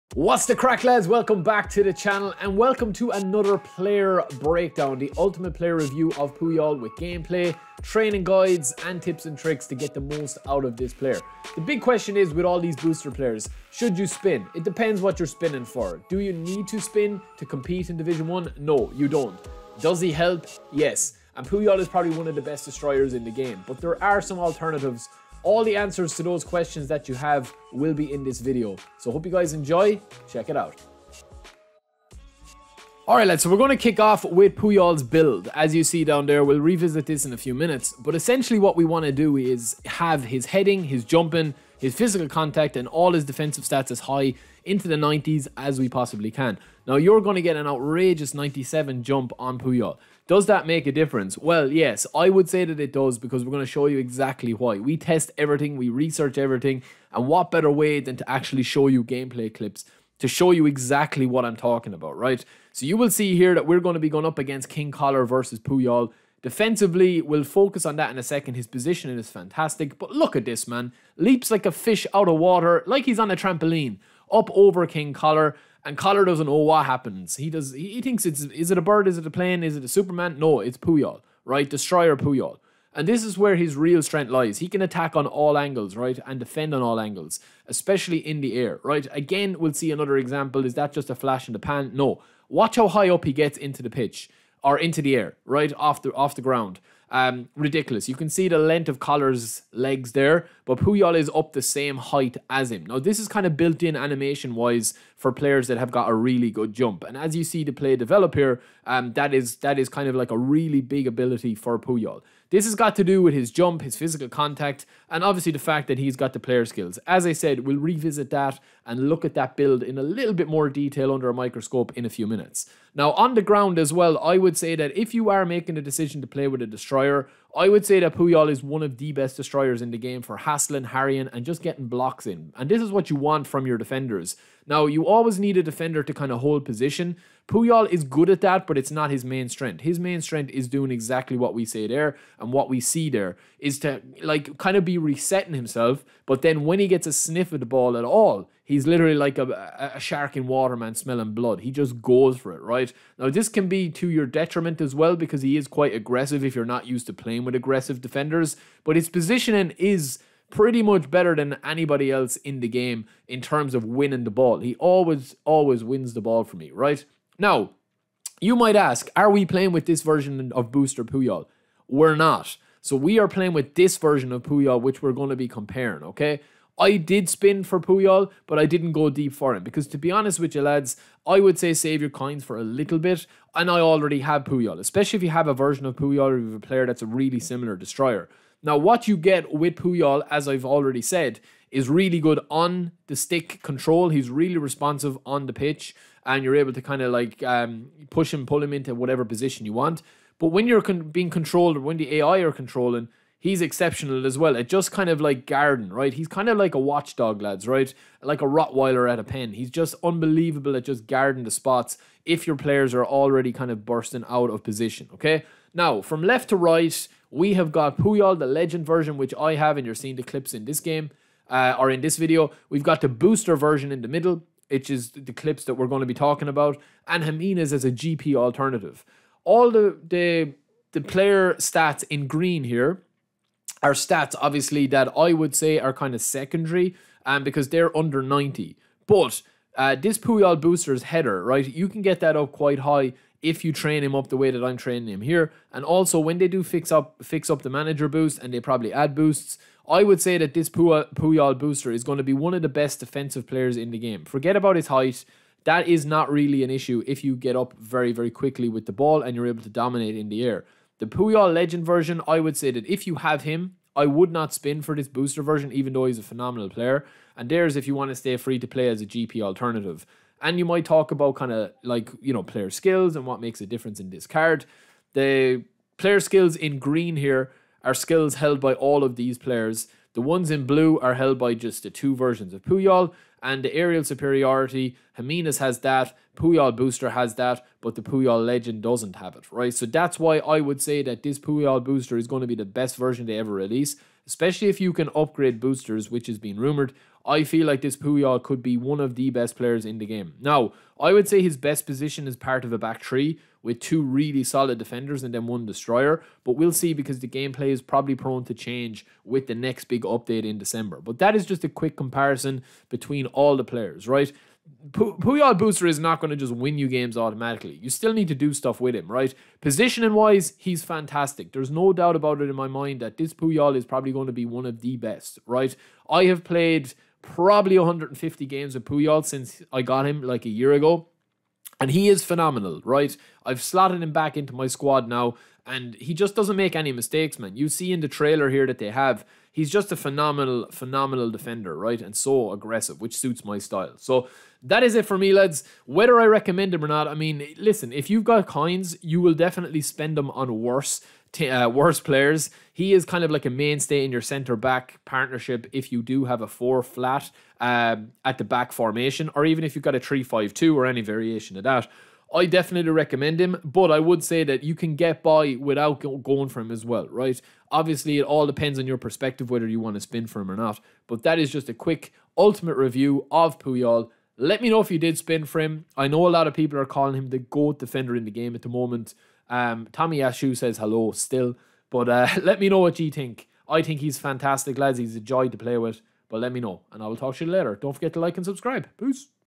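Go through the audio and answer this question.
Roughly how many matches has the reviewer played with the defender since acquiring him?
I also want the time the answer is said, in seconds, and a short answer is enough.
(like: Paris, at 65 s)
150, at 327 s.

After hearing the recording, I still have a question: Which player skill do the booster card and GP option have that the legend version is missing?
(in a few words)
Aerial superiority.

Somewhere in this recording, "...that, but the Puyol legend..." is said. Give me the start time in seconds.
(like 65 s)
287 s.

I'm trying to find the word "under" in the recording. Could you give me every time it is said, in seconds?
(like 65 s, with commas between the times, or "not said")
121 s, 237 s.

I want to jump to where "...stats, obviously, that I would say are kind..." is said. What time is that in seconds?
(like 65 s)
233 s.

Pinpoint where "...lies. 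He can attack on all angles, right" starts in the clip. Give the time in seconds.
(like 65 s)
84 s.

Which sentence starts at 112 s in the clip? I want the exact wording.
This has got to do with his jump, his physical contact, and obviously the fact that he's got the player skills.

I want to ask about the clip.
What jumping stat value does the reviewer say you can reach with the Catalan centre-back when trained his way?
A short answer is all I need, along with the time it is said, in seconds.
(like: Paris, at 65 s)
97, at 48 s.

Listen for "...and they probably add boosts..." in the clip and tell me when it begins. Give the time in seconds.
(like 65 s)
248 s.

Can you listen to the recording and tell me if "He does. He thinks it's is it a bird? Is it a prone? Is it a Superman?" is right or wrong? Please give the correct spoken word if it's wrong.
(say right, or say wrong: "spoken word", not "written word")
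wrong: "plane", not "prone".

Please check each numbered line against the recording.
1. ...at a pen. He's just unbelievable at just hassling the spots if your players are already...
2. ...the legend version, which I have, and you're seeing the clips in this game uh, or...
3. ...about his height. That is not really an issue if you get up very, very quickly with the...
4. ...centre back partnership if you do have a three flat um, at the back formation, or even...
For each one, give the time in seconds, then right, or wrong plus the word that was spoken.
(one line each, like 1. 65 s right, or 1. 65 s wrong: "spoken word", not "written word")
1. 209 s wrong: "guarding", not "hassling"
2. 218 s right
3. 254 s right
4. 354 s wrong: "four", not "three".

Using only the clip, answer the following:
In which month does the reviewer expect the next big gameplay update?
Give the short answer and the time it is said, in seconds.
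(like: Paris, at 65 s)
December, at 310 s.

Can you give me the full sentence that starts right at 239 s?
But uh, this Puyol booster's header, right?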